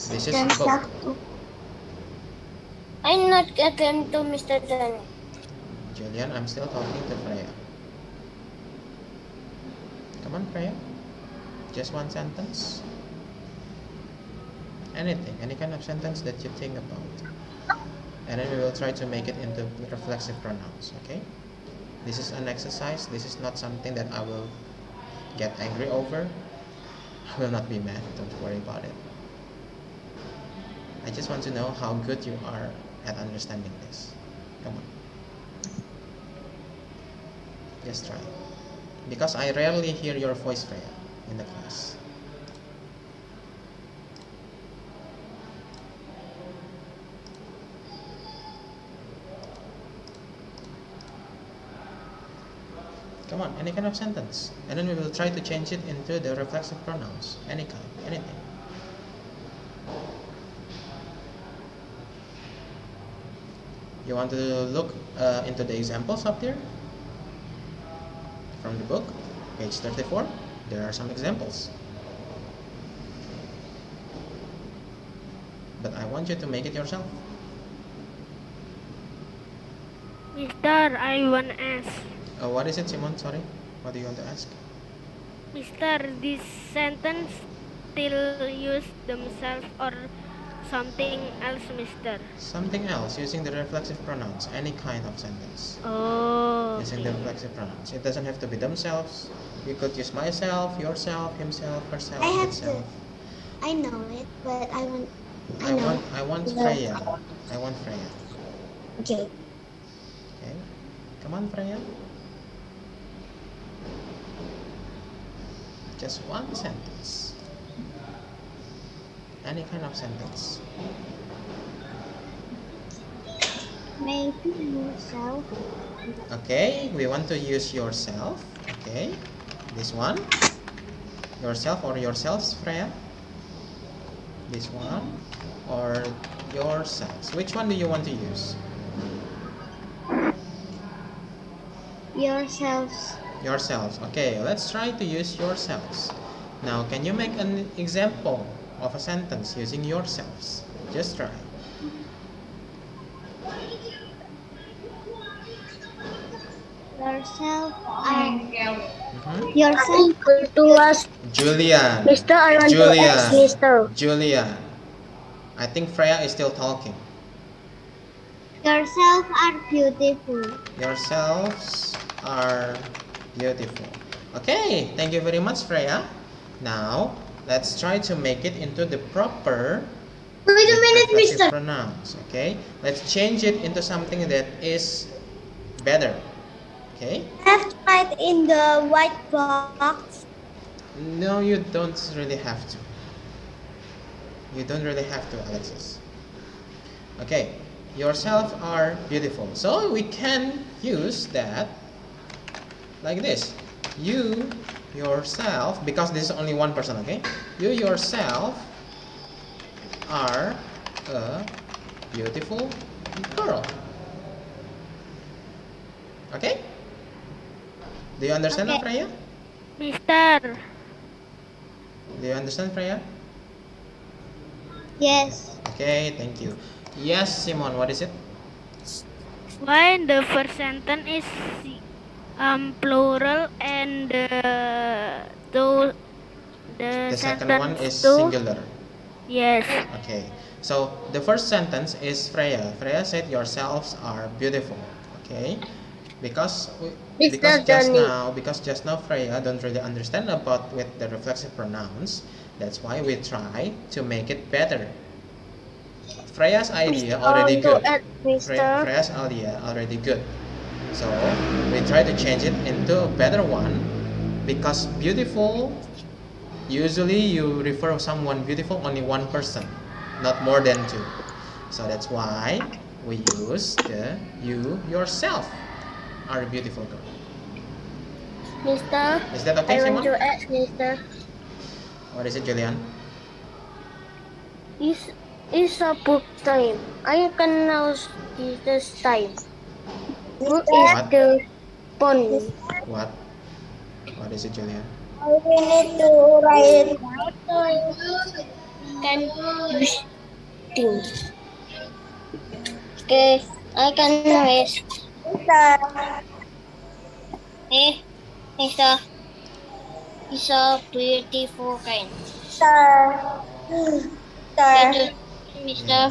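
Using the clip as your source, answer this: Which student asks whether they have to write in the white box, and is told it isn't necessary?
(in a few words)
Alexis.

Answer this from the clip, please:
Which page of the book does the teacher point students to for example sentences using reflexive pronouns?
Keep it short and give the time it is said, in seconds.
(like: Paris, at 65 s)
34, at 69 s.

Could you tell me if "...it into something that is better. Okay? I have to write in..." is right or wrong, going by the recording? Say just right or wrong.
right.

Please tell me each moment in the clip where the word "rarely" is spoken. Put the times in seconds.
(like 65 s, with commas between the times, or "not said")
39 s.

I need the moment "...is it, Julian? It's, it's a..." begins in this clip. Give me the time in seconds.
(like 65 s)
282 s.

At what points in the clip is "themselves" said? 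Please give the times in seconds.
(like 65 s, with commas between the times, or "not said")
89 s, 98 s.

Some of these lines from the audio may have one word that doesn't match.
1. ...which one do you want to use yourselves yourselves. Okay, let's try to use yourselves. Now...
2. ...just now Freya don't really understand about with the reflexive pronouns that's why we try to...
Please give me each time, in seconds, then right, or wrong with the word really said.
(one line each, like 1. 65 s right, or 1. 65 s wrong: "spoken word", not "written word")
1. 137 s right
2. 248 s right.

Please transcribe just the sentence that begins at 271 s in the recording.
So that's why we use the you yourself are a beautiful girl.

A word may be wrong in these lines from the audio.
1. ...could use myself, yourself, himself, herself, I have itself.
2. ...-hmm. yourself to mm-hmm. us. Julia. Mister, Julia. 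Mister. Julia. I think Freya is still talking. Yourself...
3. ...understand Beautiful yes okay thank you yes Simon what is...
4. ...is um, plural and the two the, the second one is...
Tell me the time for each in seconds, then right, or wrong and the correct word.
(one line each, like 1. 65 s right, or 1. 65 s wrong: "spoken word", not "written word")
1. 99 s right
2. 158 s right
3. 222 s wrong: "Freya", not "Beautiful"
4. 231 s right.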